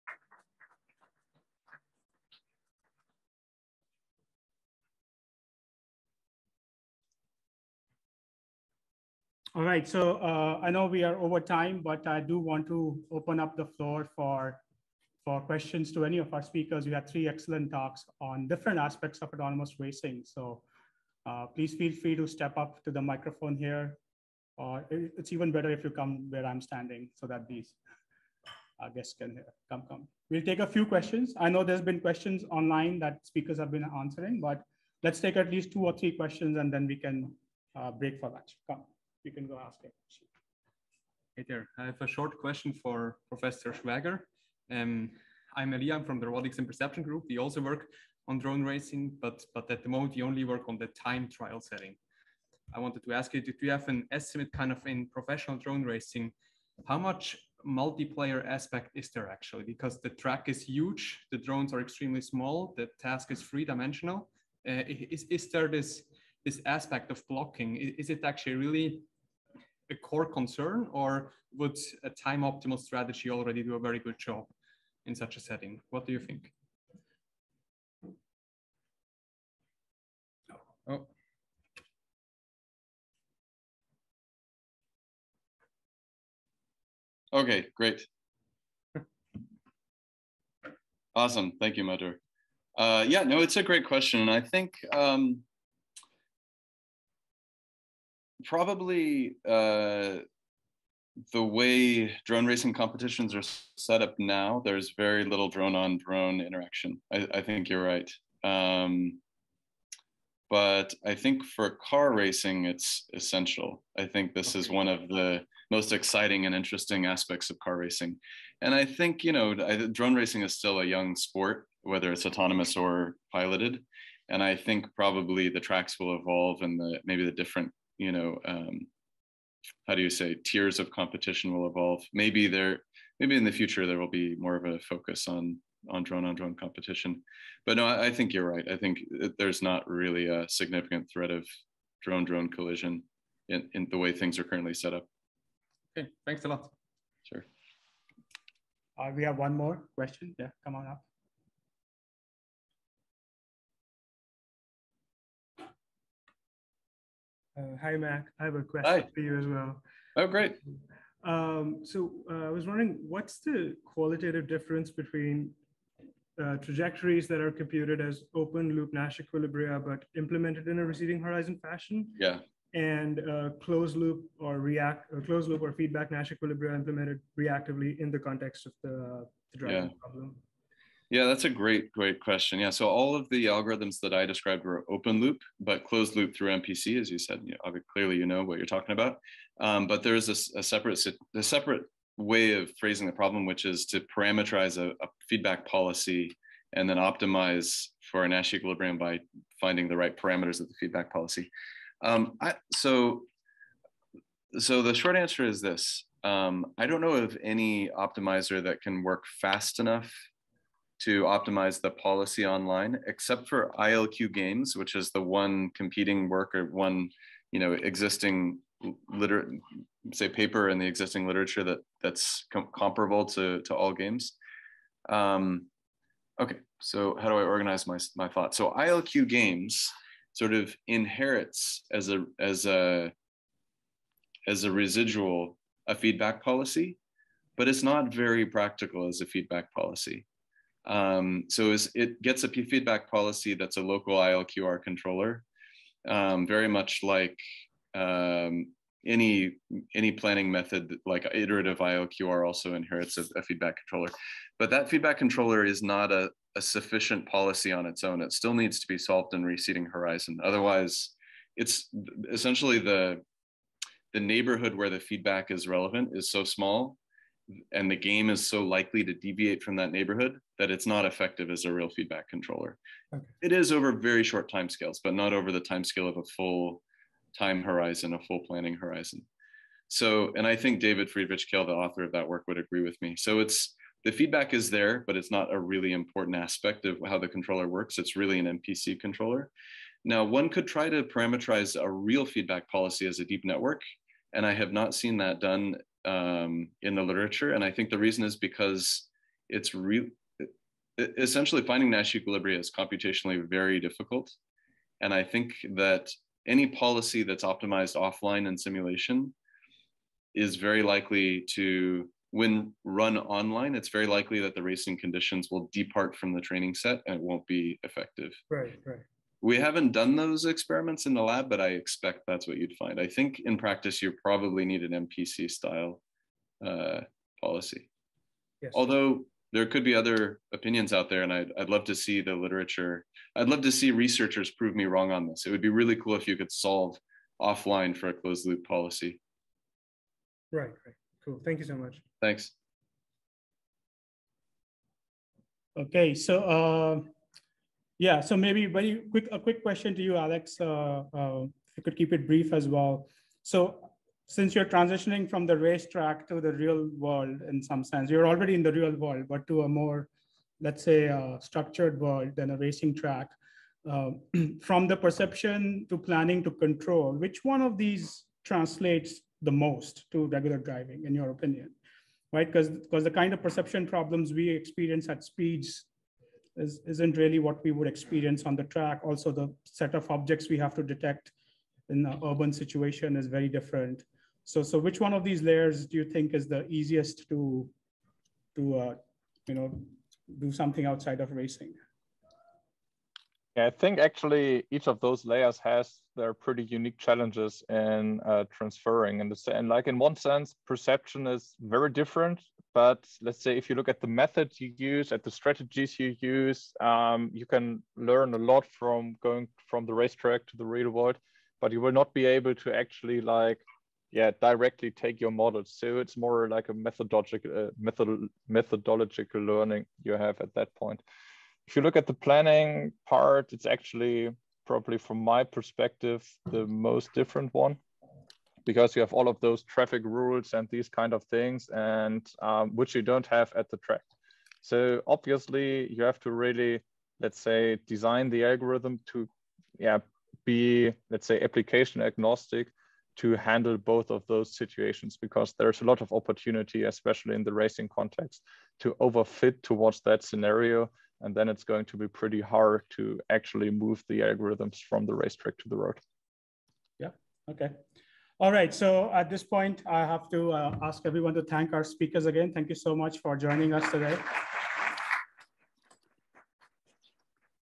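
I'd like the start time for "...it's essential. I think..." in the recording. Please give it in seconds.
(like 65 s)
112 s.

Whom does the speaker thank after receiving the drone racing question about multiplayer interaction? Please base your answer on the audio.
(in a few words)
Madhur.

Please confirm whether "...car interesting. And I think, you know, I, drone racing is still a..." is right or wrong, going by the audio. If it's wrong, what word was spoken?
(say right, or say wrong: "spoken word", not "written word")
wrong: "racing", not "interesting".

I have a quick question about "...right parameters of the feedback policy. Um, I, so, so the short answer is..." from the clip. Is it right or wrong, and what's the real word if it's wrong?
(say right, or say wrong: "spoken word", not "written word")
right.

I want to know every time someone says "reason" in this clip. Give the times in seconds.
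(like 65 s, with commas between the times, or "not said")
297 s.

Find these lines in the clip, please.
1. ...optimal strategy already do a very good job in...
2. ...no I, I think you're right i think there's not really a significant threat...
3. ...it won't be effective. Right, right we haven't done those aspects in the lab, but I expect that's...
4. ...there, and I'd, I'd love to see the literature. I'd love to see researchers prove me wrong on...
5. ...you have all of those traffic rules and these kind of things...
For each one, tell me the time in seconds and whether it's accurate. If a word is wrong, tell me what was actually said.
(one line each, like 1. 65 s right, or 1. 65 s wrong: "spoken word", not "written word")
1. 72 s right
2. 137 s right
3. 317 s wrong: "experiments", not "aspects"
4. 331 s right
5. 428 s right.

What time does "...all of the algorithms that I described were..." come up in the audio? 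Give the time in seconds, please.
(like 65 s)
182 s.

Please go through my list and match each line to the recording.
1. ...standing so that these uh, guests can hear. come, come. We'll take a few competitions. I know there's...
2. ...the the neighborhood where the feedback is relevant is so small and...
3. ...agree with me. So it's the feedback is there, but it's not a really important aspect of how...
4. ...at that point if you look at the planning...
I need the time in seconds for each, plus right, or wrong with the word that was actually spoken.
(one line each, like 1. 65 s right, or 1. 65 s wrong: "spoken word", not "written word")
1. 26 s wrong: "questions", not "competitions"
2. 262 s right
3. 282 s right
4. 420 s right.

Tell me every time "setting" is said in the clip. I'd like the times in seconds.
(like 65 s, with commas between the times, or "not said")
51 s, 75 s.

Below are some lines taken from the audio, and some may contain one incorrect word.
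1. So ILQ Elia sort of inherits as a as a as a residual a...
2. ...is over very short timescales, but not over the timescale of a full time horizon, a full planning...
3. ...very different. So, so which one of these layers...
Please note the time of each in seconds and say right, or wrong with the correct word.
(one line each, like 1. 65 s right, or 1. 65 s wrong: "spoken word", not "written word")
1. 228 s wrong: "Games", not "Elia"
2. 273 s right
3. 383 s right.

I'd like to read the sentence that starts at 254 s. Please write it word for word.
But that feedback controller is not a, a, sufficient policy on its own.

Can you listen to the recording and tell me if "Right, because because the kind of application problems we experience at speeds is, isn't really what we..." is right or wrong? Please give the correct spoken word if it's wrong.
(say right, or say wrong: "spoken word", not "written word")
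wrong: "perception", not "application".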